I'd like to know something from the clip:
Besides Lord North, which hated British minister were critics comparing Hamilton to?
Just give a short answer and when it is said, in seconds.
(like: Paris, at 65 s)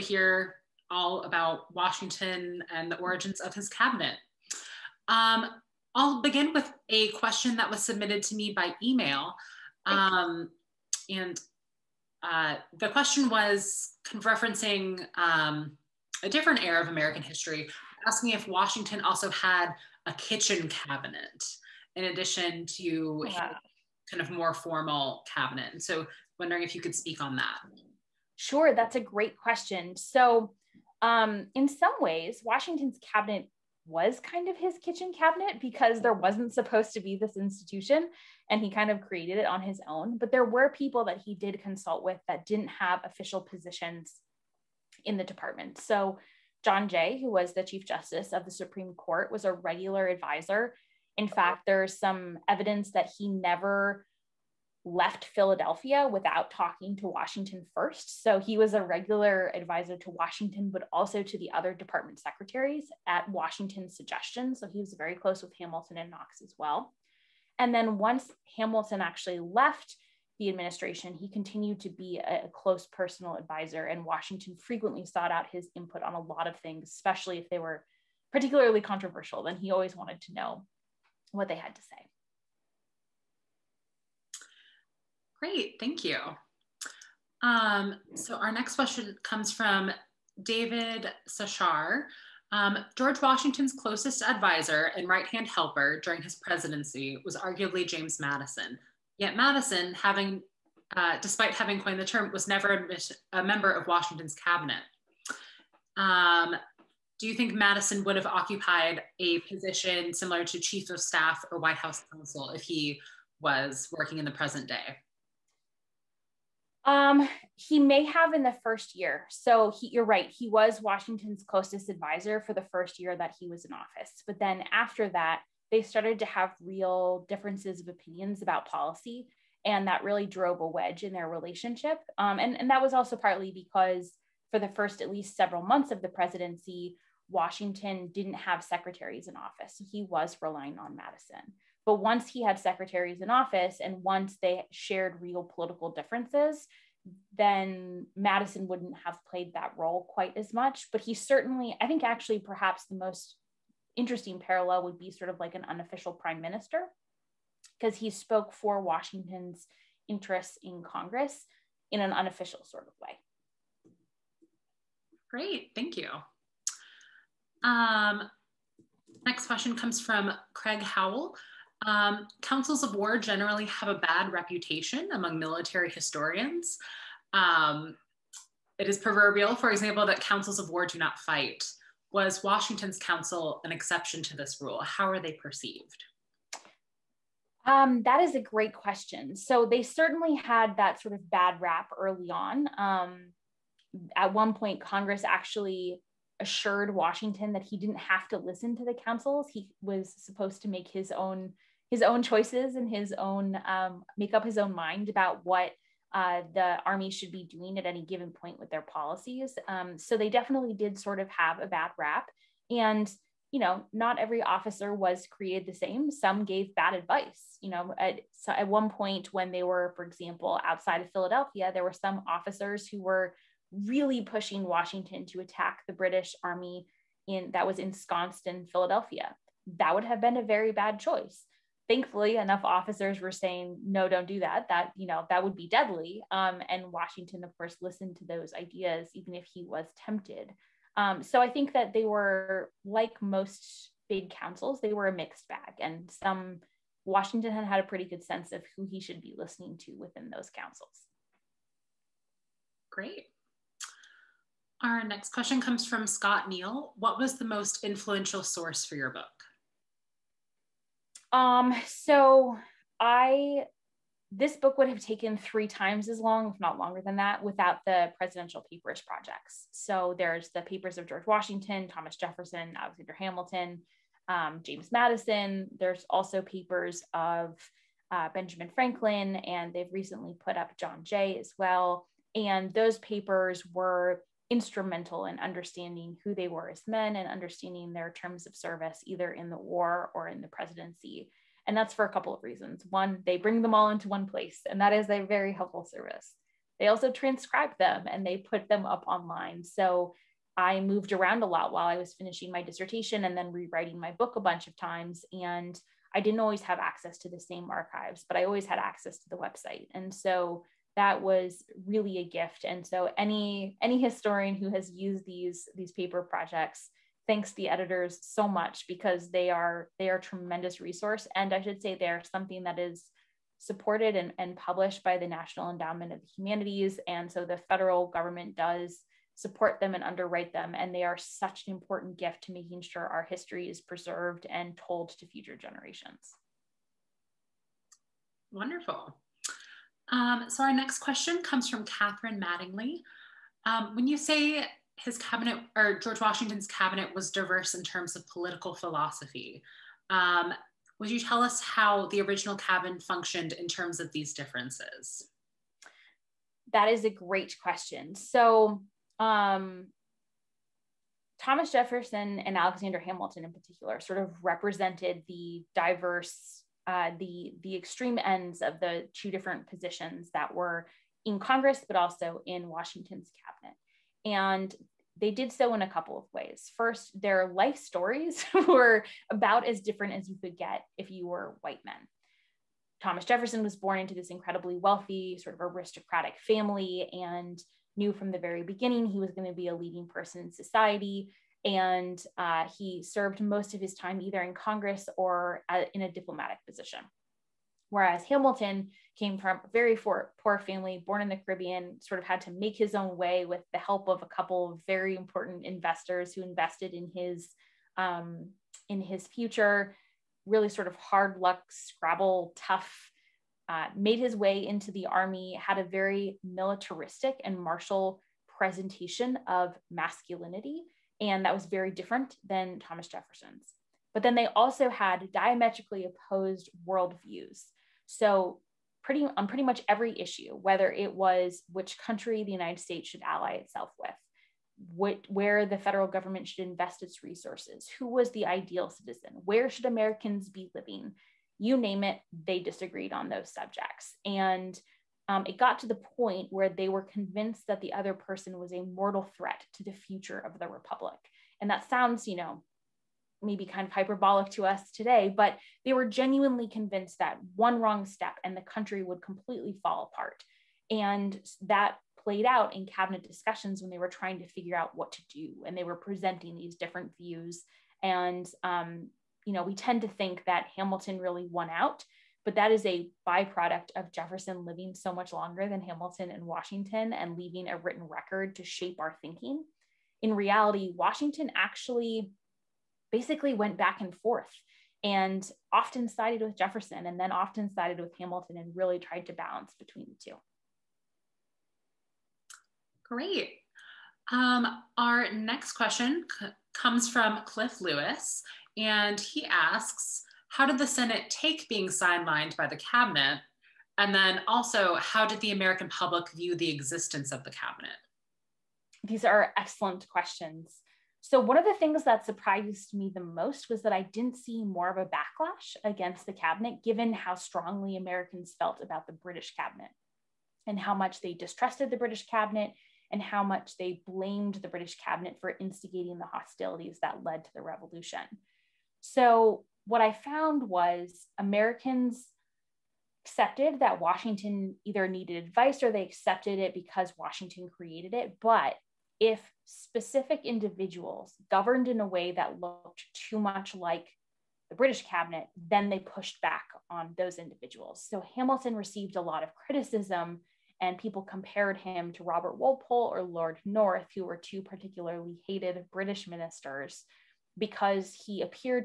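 Robert Walpole, at 552 s.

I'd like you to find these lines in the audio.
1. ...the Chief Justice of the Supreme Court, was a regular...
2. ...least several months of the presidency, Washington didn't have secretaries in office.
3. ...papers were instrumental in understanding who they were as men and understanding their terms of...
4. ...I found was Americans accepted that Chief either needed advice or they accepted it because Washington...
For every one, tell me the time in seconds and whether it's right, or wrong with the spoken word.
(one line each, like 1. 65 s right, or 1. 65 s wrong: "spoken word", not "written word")
1. 47 s right
2. 135 s right
3. 282 s right
4. 530 s wrong: "Washington", not "Chief".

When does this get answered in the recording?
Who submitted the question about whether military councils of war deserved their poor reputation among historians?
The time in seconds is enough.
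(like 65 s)
170 s.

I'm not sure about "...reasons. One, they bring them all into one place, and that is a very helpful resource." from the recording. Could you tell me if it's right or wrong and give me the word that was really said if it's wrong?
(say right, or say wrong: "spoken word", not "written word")
wrong: "service", not "resource".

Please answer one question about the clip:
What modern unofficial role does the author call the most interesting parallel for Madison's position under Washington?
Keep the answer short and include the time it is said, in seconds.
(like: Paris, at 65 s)
Unofficial prime minister, at 155 s.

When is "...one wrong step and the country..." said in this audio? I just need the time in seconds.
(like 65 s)
457 s.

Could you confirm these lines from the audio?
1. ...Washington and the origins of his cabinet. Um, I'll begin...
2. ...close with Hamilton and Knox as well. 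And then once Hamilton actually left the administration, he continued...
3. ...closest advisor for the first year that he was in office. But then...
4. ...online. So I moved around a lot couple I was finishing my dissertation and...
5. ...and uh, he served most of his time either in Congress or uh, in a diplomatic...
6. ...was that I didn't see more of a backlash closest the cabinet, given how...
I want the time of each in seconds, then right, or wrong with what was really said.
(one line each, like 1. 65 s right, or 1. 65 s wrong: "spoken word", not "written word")
1. 1 s right
2. 65 s right
3. 121 s right
4. 299 s wrong: "while", not "couple"
5. 391 s right
6. 513 s wrong: "against", not "closest".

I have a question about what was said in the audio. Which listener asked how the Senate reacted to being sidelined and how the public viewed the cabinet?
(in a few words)
Cliff Lewis.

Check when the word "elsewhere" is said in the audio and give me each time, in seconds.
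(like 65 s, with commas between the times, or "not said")
not said.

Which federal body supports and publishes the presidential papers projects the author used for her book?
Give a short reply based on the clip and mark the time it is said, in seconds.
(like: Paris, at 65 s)
National Endowment of the Humanities, at 325 s.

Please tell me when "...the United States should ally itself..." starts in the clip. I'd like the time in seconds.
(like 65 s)
432 s.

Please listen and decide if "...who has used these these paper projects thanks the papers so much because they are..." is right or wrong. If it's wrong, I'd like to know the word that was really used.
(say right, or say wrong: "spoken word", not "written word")
wrong: "editors", not "papers".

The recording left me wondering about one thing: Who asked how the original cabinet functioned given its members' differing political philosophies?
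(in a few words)
Catherine Mattingly.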